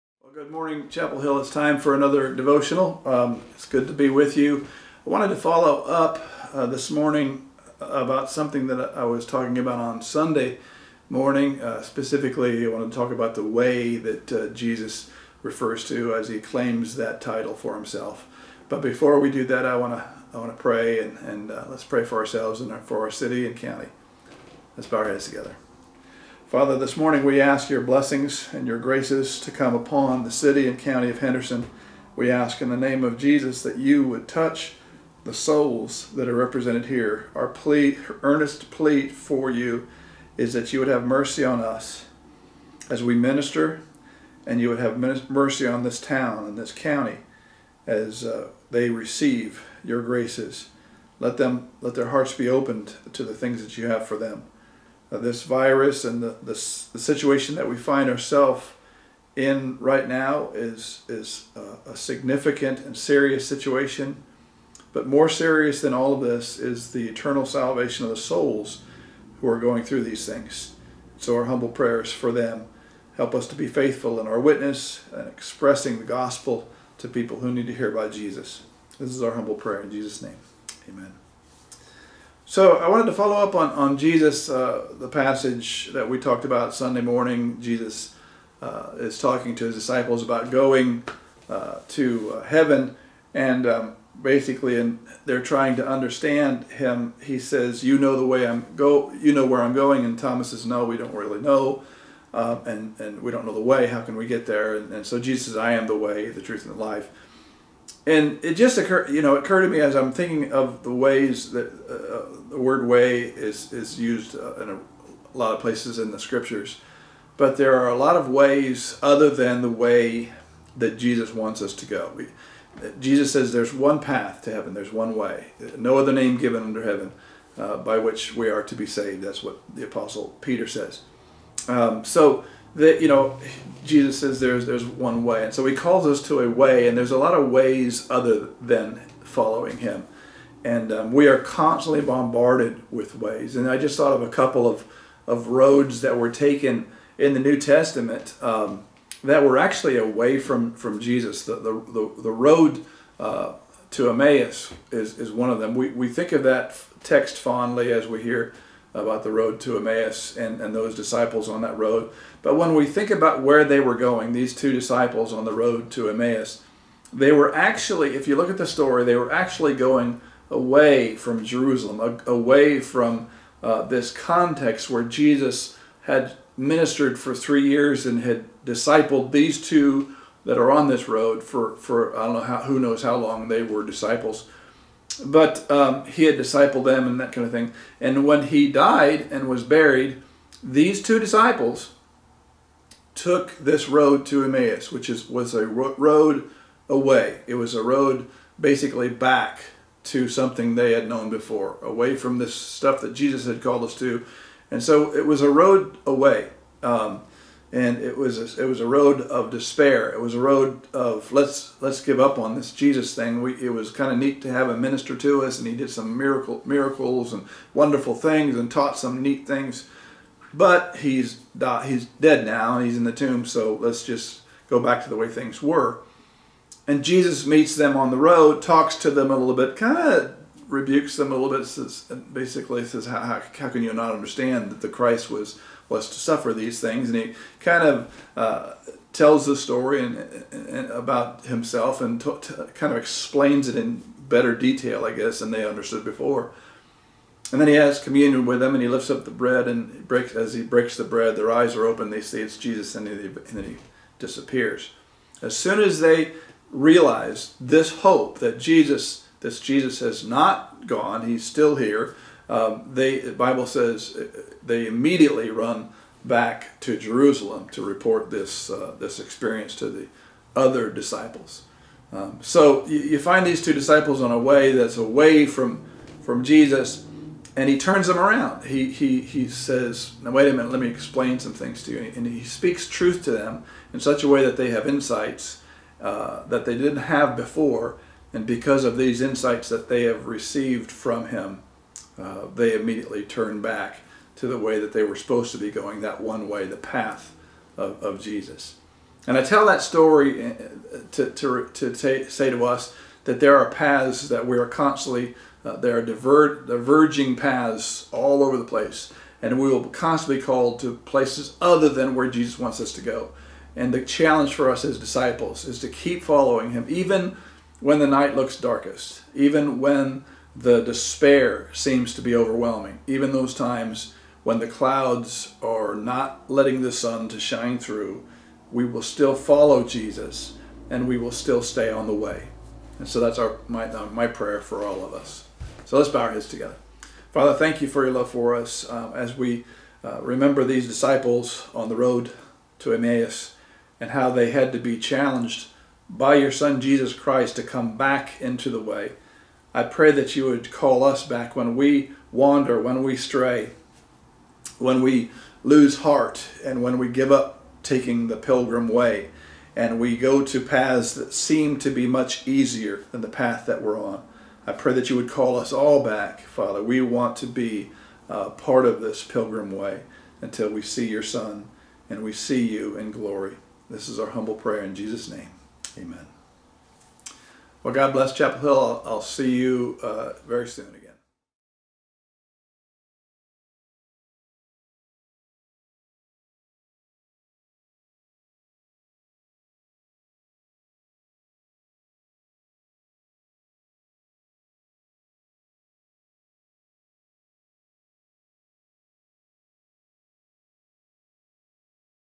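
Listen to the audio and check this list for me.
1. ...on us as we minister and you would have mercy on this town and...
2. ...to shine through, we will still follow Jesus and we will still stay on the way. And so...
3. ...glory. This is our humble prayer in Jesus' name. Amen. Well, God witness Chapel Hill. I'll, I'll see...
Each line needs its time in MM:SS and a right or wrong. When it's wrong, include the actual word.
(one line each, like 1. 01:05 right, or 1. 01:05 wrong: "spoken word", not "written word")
1. 00:41 right
2. 05:27 right
3. 06:13 wrong: "bless", not "witness".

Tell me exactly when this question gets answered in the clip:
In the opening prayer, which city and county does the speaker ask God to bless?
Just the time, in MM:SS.
00:31.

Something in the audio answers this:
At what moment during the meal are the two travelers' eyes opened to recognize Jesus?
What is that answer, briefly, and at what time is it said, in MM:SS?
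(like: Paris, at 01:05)
as he breaks the bread, at 04:10.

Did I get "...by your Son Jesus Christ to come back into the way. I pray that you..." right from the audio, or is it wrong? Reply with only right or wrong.
right.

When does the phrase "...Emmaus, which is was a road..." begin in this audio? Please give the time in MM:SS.
03:14.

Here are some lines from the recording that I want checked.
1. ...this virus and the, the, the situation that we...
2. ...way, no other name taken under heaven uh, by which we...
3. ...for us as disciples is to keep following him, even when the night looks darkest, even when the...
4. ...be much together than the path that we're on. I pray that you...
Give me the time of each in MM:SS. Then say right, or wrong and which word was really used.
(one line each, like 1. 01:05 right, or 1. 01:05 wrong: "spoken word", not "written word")
1. 00:55 right
2. 02:05 wrong: "given", not "taken"
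3. 05:14 right
4. 06:01 wrong: "easier", not "together".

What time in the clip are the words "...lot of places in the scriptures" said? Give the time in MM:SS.
01:55.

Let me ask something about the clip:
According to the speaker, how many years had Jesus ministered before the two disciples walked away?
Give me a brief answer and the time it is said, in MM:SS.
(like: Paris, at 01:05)
3, at 02:57.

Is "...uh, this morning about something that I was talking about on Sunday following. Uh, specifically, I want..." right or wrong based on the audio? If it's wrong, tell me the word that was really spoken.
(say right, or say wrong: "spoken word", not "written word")
wrong: "morning", not "following".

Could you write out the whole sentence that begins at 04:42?
And he speaks truth to them in such a way that they have insights uh, that they didn't have before.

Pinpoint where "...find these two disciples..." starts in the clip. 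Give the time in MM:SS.
04:33.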